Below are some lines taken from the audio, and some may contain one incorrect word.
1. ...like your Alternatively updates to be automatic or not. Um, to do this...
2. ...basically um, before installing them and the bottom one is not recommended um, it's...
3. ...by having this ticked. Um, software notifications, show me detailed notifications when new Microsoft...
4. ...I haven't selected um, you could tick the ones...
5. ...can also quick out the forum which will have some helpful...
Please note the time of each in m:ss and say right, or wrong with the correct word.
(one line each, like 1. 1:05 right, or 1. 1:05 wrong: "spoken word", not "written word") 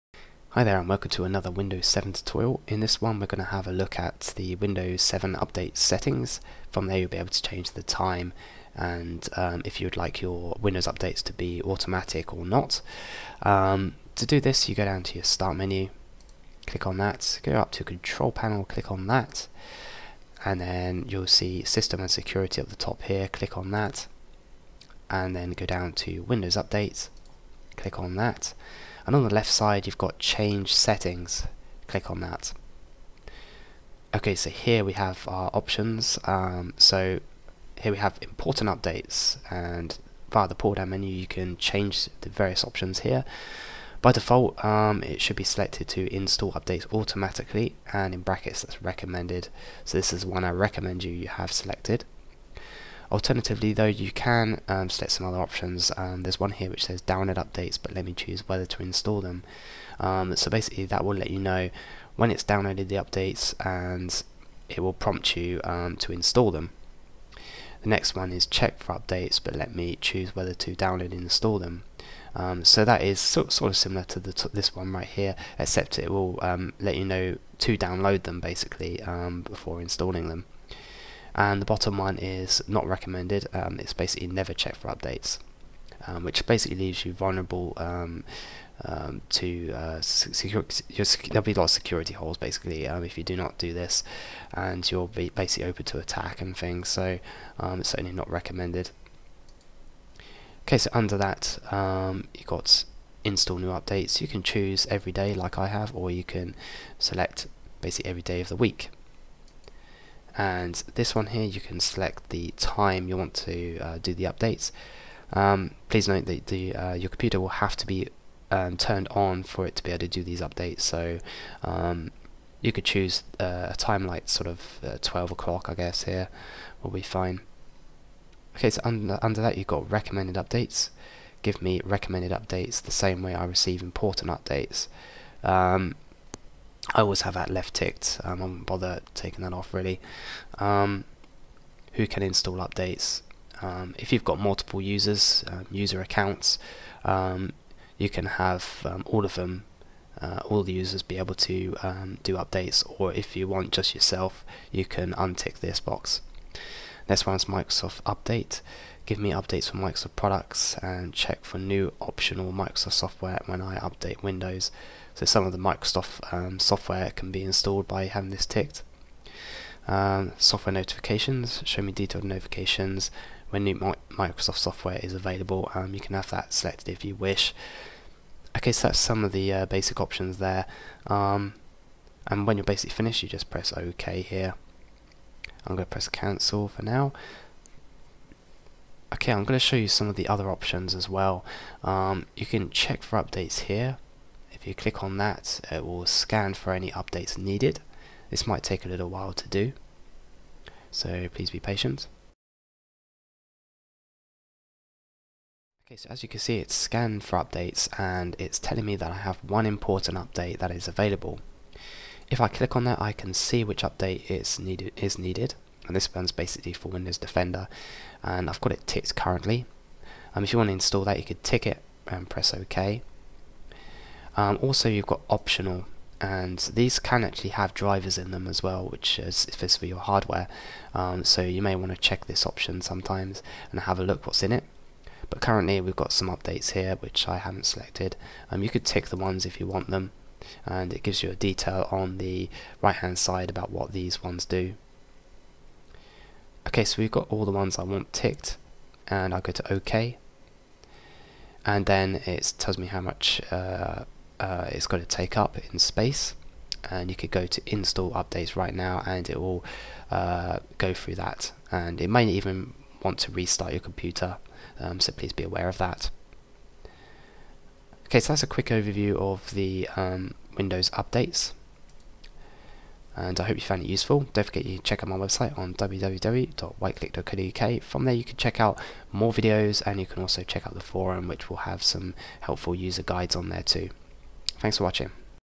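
1. 0:09 wrong: "Windows", not "Alternatively"
2. 1:18 right
3. 2:47 right
4. 3:57 right
5. 4:40 wrong: "check", not "quick".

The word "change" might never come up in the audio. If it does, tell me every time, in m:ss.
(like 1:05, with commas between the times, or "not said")
0:07, 0:30, 0:41.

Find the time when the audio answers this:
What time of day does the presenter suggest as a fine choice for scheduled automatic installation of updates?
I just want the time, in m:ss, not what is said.
2:05.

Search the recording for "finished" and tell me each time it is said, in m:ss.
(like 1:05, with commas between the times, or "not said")
3:02.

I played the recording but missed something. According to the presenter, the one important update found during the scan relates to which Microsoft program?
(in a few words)
Windows Defender.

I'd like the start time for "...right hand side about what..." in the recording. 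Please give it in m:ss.
4:02.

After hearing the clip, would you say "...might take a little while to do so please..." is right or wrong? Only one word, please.
right.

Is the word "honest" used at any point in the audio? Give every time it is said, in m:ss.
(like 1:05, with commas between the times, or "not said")
not said.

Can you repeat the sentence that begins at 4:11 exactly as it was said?
And then it tells me how much uh, uh, it's going to take up in space.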